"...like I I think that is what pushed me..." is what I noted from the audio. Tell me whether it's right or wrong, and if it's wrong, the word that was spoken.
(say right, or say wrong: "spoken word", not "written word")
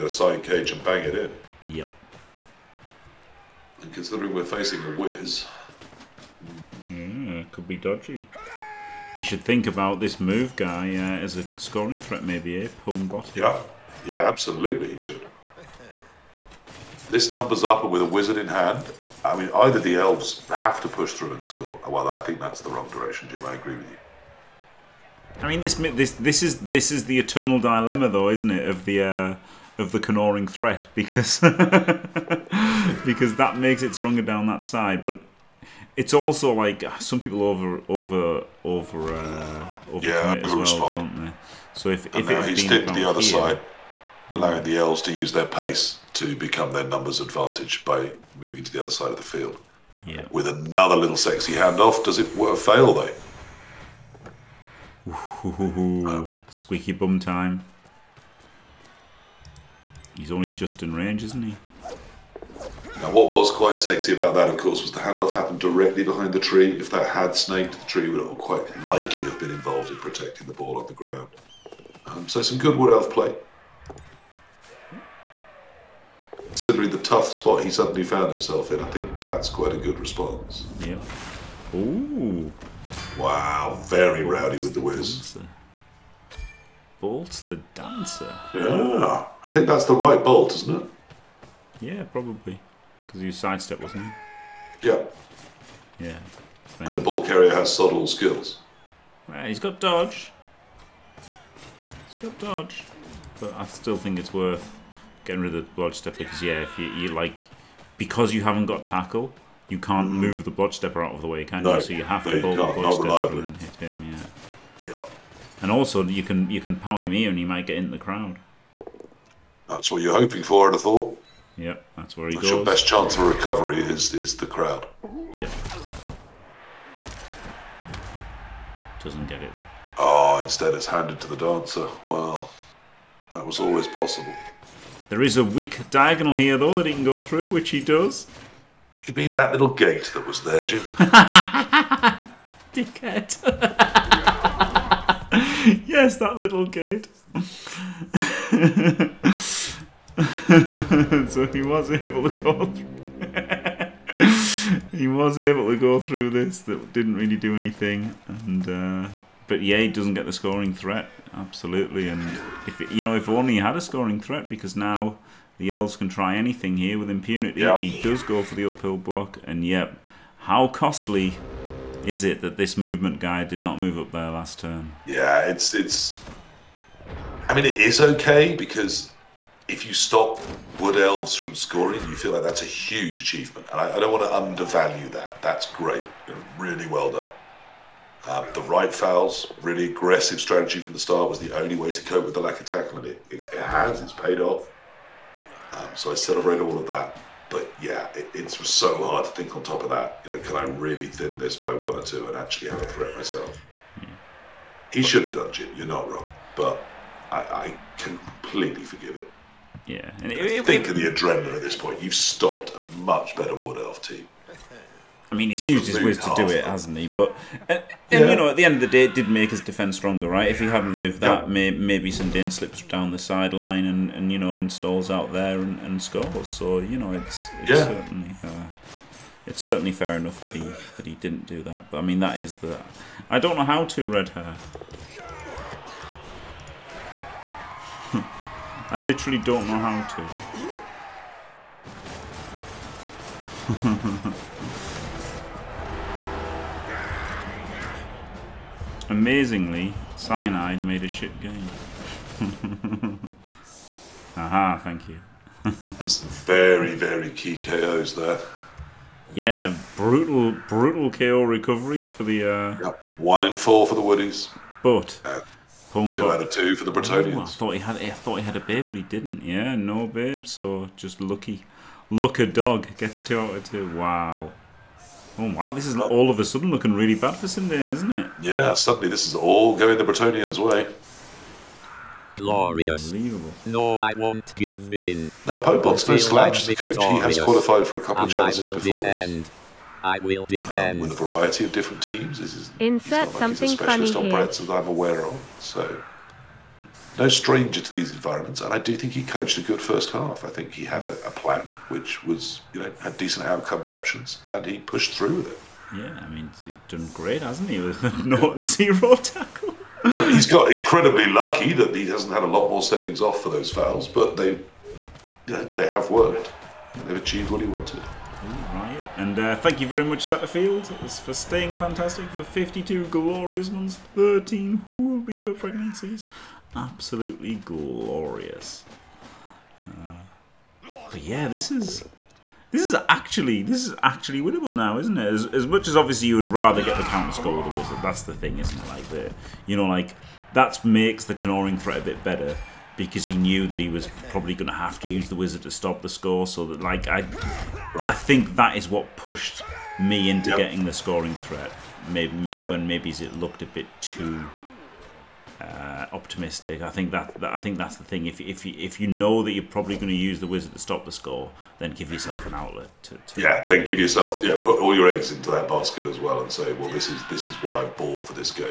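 right.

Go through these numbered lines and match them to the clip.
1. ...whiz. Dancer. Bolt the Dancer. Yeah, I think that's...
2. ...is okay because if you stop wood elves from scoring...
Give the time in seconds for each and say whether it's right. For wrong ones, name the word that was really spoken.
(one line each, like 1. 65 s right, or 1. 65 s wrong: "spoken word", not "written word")
1. 84 s right
2. 177 s right.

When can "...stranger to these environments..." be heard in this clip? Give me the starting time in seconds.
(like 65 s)
297 s.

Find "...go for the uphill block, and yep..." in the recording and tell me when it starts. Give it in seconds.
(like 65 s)
168 s.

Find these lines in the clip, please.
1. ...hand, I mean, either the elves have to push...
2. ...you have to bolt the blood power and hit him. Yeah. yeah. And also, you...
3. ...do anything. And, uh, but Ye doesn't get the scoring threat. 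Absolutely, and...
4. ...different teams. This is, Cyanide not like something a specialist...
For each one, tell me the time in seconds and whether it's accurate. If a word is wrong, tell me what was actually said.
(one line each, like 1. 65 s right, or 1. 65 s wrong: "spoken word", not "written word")
1. 18 s right
2. 111 s wrong: "stepper", not "power"
3. 157 s right
4. 291 s wrong: "Insert", not "Cyanide".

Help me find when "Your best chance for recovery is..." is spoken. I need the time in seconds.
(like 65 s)
122 s.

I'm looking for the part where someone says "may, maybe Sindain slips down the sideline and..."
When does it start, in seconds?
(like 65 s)
221 s.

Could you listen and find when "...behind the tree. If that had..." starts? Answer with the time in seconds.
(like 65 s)
66 s.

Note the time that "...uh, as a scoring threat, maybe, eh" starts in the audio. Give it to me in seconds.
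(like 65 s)
10 s.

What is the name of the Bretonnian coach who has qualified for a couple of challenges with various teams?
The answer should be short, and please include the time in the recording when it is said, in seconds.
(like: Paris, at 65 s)
Pwnbot, at 285 s.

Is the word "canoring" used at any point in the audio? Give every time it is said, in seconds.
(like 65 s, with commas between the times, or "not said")
29 s, 341 s.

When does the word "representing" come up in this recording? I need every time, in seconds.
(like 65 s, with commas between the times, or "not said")
not said.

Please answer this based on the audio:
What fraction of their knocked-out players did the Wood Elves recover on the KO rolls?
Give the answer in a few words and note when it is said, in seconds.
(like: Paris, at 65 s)
1 in 4, at 263 s.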